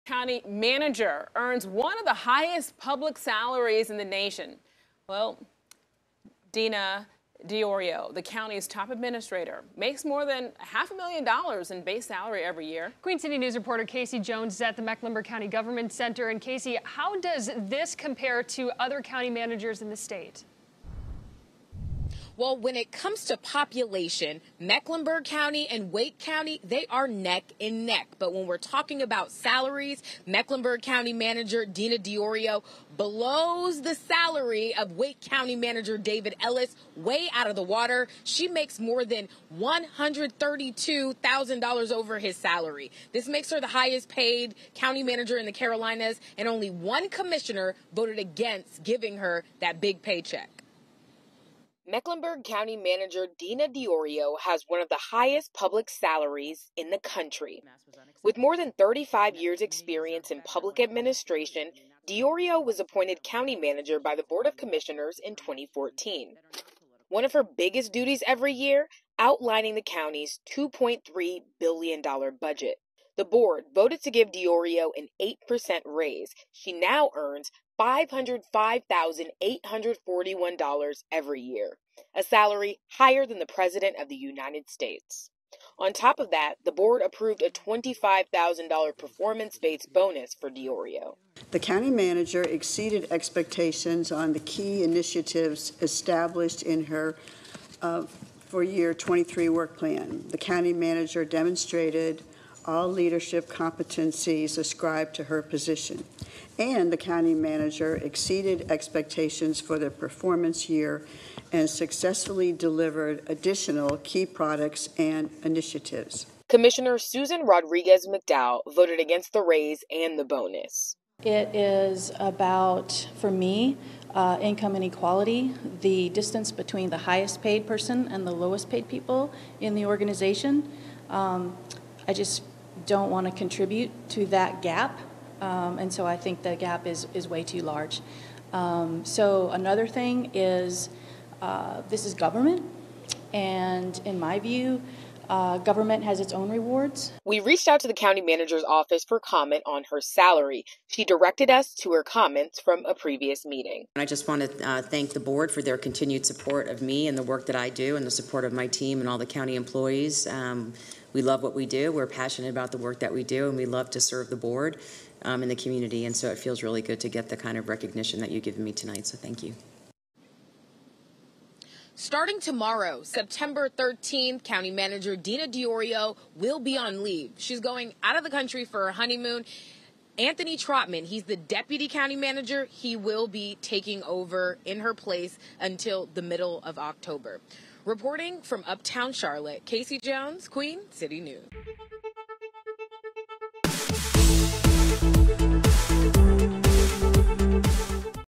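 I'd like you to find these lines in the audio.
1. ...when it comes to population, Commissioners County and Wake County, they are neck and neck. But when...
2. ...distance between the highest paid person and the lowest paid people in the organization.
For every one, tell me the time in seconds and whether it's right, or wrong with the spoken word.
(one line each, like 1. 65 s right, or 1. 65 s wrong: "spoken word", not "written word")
1. 22 s wrong: "Mecklenburg", not "Commissioners"
2. 126 s right.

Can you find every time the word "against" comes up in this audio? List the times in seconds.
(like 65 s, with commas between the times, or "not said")
48 s, 118 s.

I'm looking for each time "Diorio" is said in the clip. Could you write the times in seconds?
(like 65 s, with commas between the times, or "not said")
7 s, 31 s, 53 s, 62 s, 74 s, 90 s, 175 s.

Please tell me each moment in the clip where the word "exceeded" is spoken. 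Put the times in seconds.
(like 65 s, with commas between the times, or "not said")
92 s, 107 s.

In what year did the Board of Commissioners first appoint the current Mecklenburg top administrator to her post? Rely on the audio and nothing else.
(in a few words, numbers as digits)
2014.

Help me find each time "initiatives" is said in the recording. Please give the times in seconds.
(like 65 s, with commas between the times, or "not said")
94 s, 115 s.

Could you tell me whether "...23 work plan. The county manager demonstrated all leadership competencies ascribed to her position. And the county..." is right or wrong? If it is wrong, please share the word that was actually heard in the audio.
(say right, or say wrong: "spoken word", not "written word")
right.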